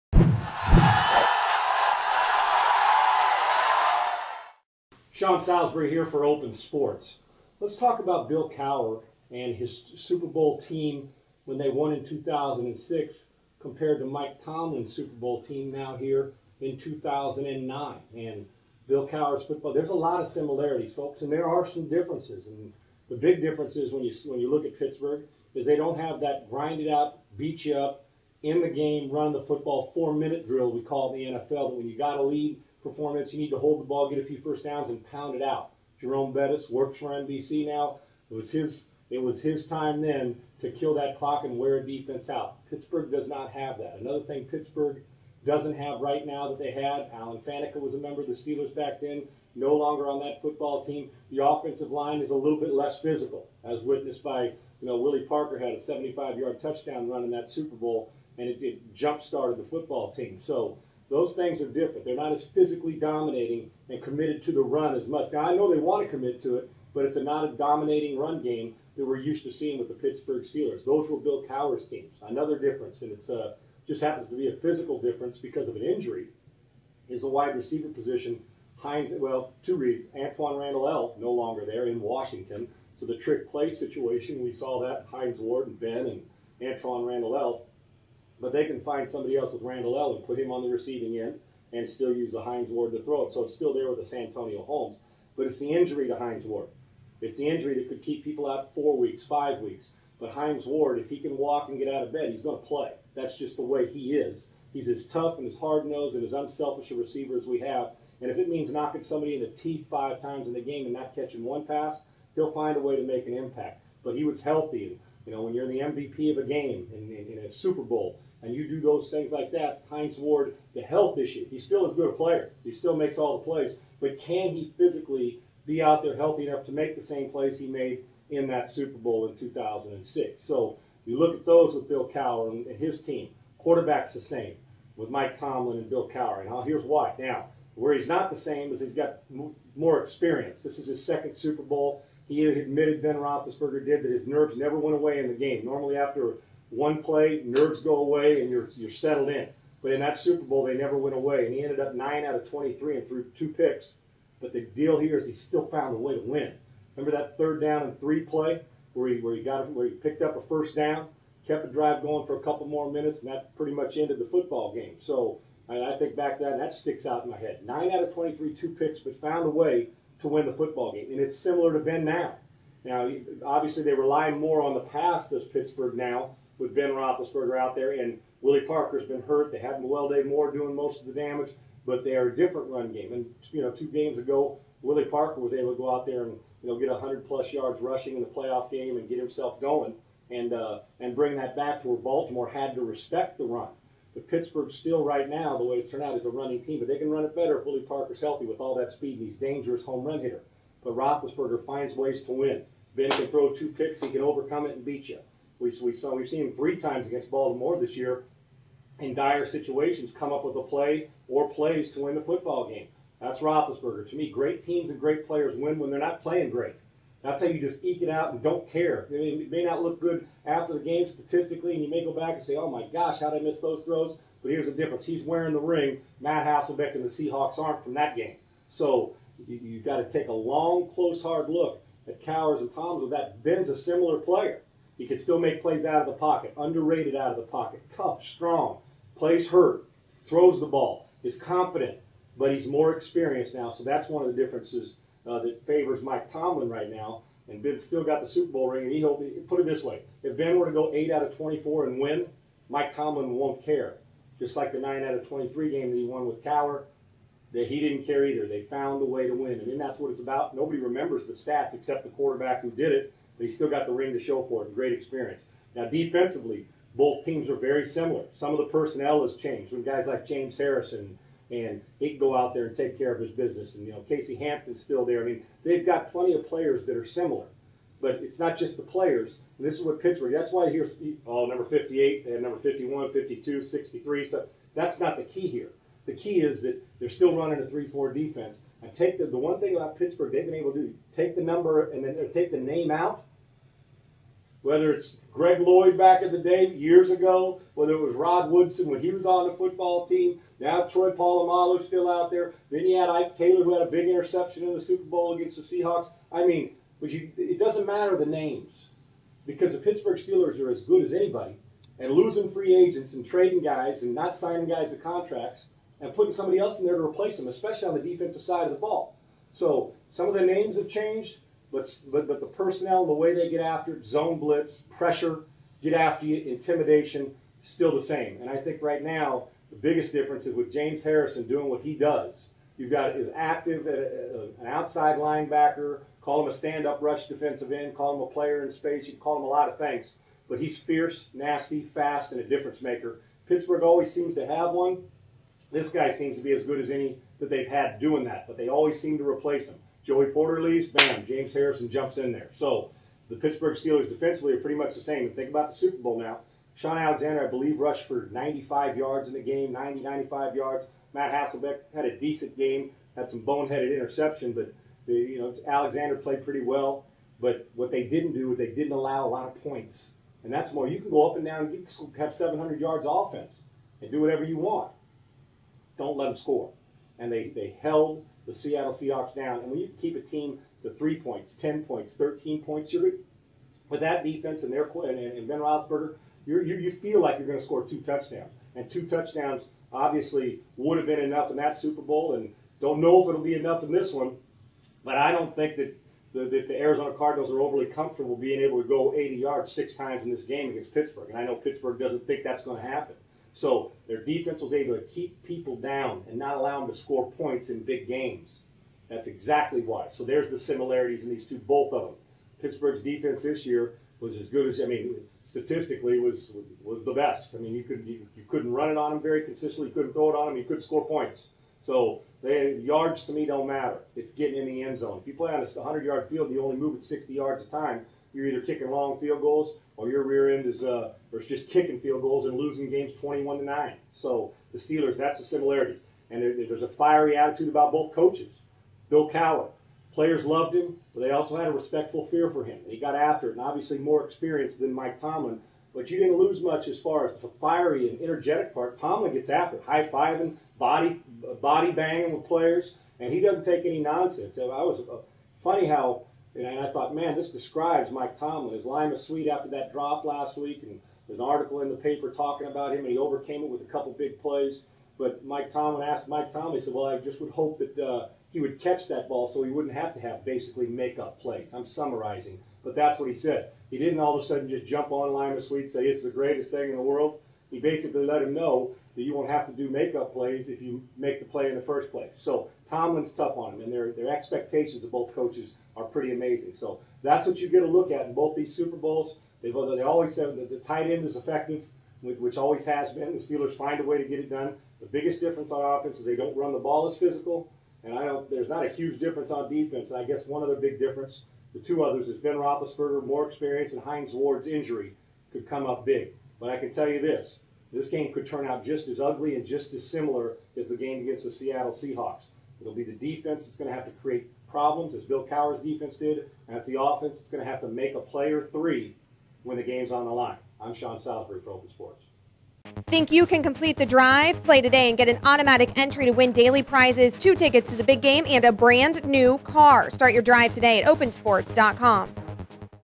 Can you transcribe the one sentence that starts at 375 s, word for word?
Don't let them score, and they they held the Seattle Seahawks down.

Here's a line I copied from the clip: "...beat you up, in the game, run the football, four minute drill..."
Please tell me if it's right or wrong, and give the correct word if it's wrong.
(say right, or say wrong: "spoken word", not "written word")
right.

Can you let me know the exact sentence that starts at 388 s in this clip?
And two touchdowns obviously would have been enough in that Super Bowl, and don't know if it'll be enough in this one.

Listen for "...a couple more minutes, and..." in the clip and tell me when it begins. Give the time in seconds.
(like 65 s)
162 s.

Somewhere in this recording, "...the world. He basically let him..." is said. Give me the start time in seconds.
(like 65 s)
476 s.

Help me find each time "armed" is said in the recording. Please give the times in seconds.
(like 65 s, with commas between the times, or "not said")
not said.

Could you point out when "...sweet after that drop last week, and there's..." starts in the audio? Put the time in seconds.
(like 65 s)
459 s.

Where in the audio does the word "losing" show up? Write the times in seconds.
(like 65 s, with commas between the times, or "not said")
312 s, 432 s.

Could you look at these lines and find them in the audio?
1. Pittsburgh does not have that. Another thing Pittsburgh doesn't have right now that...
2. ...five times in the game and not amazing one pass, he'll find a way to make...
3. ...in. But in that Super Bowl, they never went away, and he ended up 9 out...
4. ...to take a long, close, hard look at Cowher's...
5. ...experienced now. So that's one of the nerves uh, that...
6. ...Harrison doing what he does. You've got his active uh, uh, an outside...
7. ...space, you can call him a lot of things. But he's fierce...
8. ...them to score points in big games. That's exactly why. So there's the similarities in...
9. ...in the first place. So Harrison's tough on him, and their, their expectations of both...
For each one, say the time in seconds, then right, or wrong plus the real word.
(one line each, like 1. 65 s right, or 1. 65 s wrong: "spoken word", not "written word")
1. 42 s right
2. 109 s wrong: "catching", not "amazing"
3. 149 s right
4. 229 s right
5. 242 s wrong: "differences", not "nerves"
6. 331 s right
7. 338 s right
8. 406 s right
9. 481 s wrong: "Tomlin", not "Harrison".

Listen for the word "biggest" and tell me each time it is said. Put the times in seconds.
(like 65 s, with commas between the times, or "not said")
329 s, 495 s.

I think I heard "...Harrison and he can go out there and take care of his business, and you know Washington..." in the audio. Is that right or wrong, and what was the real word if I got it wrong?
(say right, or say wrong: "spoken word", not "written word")
wrong: "Casey", not "Washington".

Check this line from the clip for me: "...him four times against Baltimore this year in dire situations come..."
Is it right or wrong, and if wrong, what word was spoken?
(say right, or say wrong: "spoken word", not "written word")
wrong: "three", not "four".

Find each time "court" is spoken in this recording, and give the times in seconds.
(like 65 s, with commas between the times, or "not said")
not said.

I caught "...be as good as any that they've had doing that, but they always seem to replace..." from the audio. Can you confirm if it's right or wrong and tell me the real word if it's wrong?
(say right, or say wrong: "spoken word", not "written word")
right.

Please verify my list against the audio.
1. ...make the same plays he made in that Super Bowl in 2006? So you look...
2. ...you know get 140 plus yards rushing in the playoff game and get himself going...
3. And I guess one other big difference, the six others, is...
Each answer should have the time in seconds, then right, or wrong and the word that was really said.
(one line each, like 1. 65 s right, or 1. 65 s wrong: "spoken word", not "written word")
1. 126 s right
2. 186 s wrong: "100", not "140"
3. 500 s wrong: "two", not "six".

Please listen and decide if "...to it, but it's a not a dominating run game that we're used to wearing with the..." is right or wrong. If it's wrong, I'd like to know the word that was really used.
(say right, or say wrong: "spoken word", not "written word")
wrong: "seeing", not "wearing".